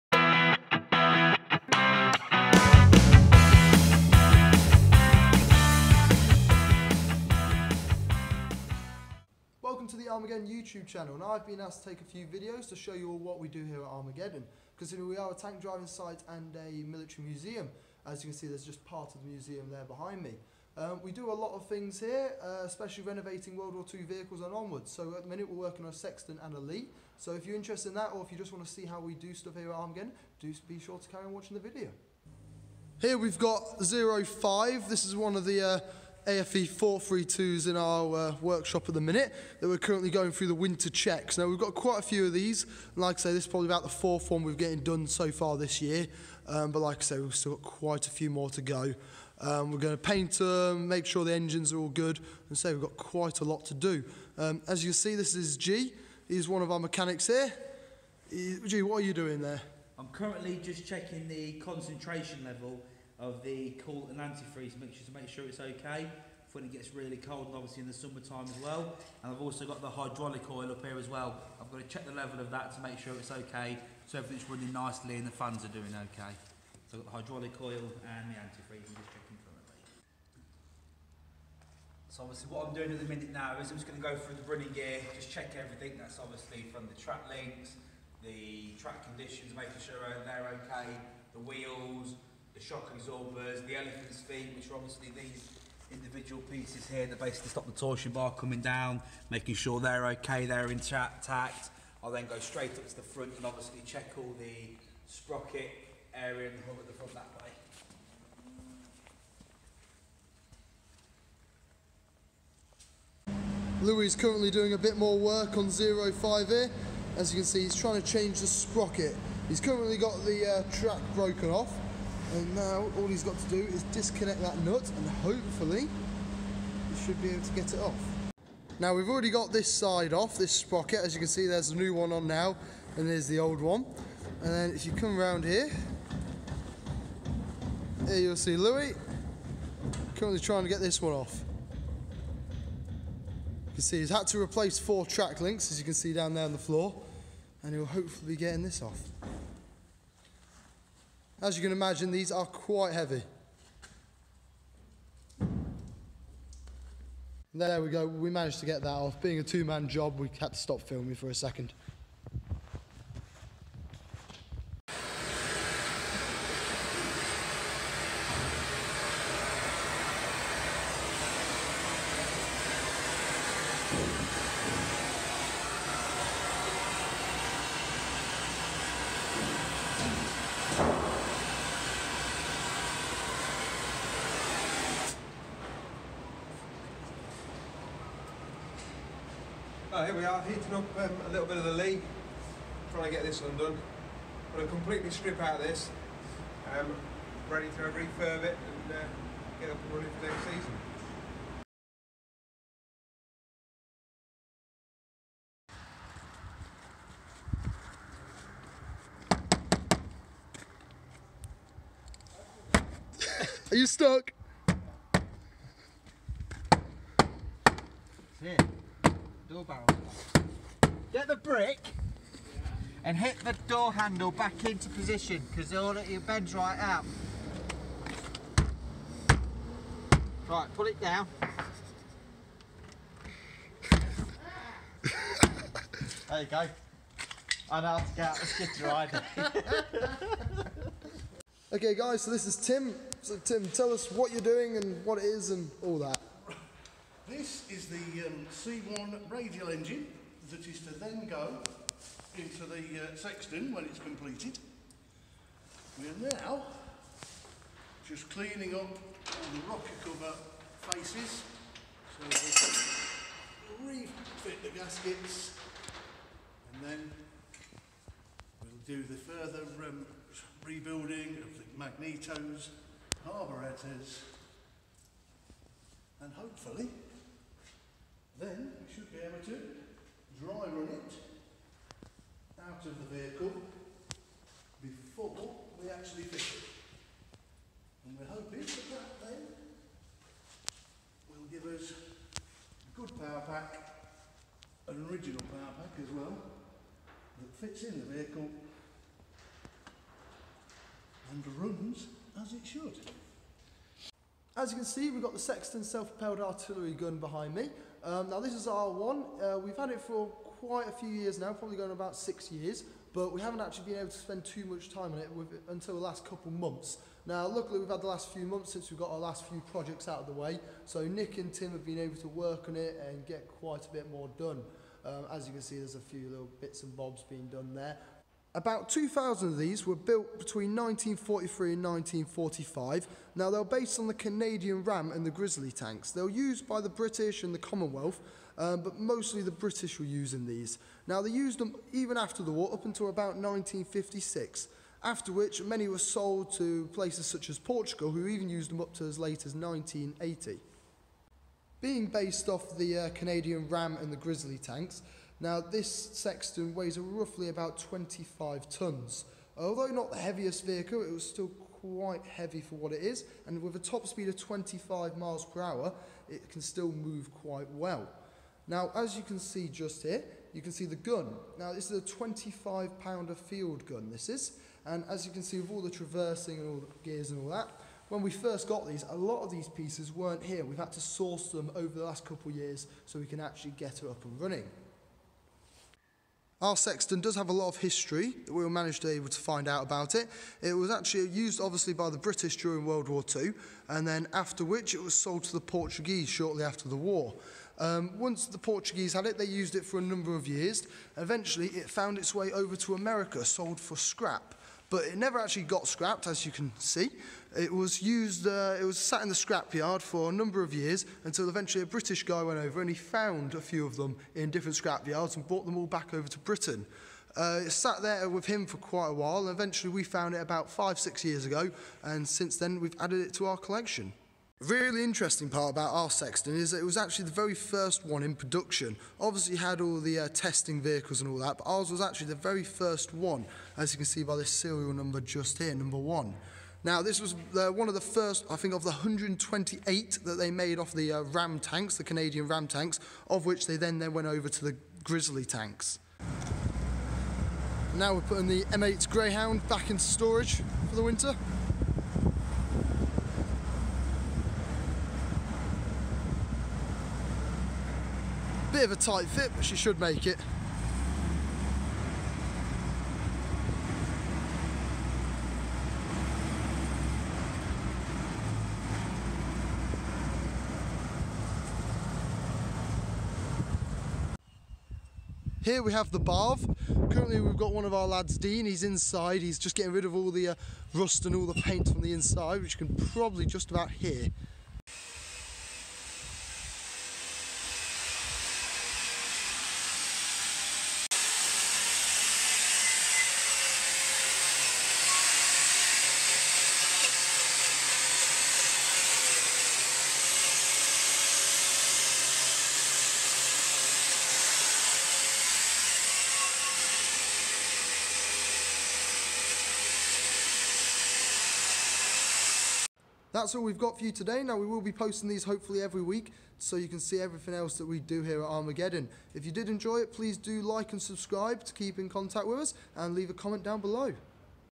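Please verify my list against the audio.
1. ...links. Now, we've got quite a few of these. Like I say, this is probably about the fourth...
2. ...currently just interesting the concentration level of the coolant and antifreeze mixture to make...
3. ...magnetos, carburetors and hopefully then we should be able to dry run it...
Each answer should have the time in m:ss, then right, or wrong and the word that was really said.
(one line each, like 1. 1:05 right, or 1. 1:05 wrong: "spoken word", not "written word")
1. 0:40 wrong: "checks", not "links"
2. 1:00 wrong: "checking", not "interesting"
3. 4:31 right.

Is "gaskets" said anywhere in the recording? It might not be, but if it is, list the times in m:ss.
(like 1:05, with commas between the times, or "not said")
4:24.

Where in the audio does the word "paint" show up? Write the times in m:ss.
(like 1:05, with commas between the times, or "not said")
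0:50, 8:01.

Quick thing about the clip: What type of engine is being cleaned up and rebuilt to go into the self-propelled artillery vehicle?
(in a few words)
C1 radial engine.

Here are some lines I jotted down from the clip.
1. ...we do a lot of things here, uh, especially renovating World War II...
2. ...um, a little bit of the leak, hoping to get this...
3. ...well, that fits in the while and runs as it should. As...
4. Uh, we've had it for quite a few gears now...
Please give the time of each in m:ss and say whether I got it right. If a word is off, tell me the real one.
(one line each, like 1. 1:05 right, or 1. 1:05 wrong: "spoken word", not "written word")
1. 0:21 right
2. 3:10 wrong: "trying", not "hoping"
3. 4:56 wrong: "vehicle", not "while"
4. 5:09 wrong: "years", not "gears".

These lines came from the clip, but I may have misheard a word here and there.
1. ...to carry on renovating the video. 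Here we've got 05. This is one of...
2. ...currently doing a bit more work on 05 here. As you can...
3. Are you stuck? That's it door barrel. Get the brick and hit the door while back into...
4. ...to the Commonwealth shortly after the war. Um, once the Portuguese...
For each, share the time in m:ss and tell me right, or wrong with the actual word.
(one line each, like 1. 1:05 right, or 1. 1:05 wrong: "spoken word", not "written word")
1. 0:30 wrong: "watching", not "renovating"
2. 1:54 right
3. 3:33 wrong: "handle", not "while"
4. 6:35 wrong: "Portuguese", not "Commonwealth".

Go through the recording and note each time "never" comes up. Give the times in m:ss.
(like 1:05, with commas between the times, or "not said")
6:45.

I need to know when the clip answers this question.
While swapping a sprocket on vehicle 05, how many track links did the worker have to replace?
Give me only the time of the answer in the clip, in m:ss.
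2:24.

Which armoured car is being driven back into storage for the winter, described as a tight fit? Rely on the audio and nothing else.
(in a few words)
M8 Greyhound.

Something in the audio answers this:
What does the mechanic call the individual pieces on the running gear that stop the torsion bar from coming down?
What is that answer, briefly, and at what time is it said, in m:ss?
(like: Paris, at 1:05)
Elephant's feet, at 1:33.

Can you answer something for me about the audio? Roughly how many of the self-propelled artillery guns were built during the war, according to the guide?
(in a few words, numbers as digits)
2,000.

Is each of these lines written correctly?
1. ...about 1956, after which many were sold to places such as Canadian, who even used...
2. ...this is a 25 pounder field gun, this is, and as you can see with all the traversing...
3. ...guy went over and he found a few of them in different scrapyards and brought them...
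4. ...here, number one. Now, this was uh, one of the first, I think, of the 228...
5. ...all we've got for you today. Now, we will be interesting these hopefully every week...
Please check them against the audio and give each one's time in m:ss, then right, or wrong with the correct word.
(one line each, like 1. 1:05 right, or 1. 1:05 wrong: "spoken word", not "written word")
1. 5:43 wrong: "Portugal", not "Canadian"
2. 6:11 right
3. 6:52 right
4. 7:15 wrong: "128", not "228"
5. 8:33 wrong: "posting", not "interesting".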